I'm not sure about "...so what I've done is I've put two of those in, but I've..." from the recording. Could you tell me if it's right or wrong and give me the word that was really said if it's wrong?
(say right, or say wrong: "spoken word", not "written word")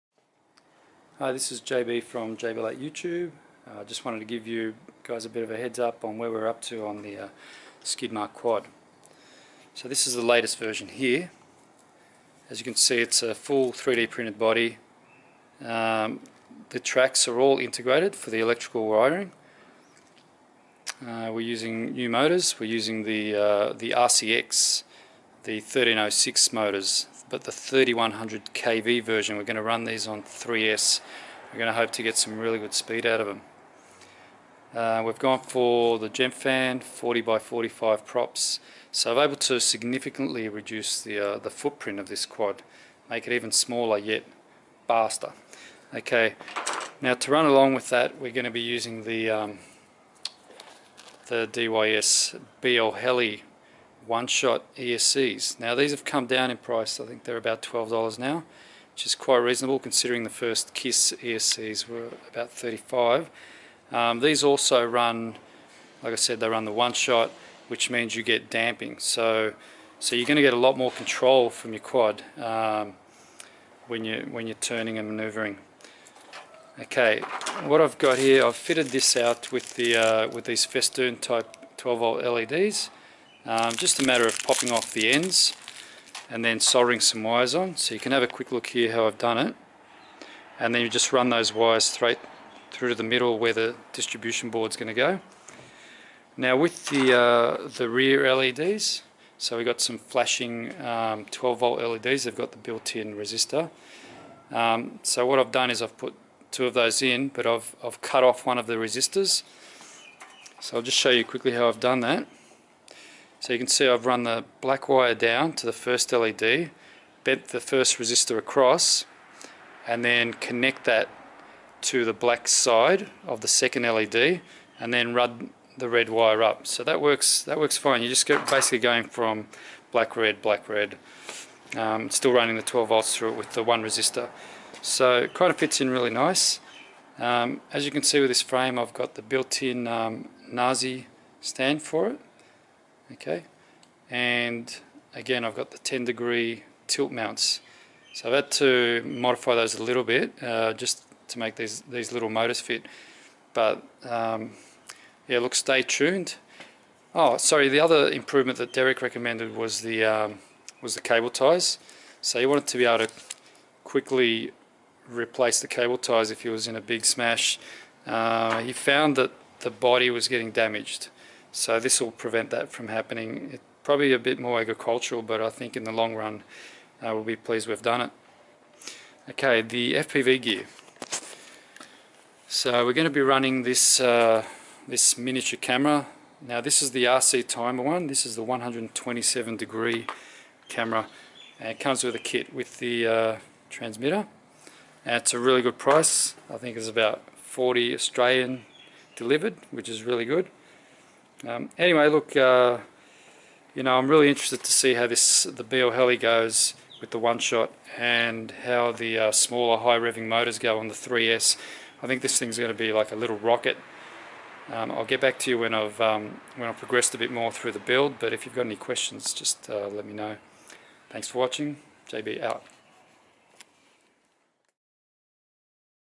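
right.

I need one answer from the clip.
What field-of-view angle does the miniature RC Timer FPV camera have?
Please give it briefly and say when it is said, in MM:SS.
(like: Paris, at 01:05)
127 degrees, at 03:08.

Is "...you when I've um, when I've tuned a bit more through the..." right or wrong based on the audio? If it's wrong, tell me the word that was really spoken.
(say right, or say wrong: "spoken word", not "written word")
wrong: "progressed", not "tuned".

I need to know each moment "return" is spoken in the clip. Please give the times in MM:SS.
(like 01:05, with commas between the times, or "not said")
not said.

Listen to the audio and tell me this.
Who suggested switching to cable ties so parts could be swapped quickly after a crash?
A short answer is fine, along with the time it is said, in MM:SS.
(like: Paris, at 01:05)
Derek, at 02:38.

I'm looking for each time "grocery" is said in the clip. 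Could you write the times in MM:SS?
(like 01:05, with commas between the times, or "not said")
not said.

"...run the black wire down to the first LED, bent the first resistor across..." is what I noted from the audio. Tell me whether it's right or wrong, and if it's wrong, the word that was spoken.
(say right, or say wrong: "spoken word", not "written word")
right.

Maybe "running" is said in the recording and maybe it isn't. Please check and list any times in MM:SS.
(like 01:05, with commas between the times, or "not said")
02:12, 03:03.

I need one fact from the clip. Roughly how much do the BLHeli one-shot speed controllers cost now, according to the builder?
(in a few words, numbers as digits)
$12.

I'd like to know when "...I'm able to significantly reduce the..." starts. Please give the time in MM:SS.
00:39.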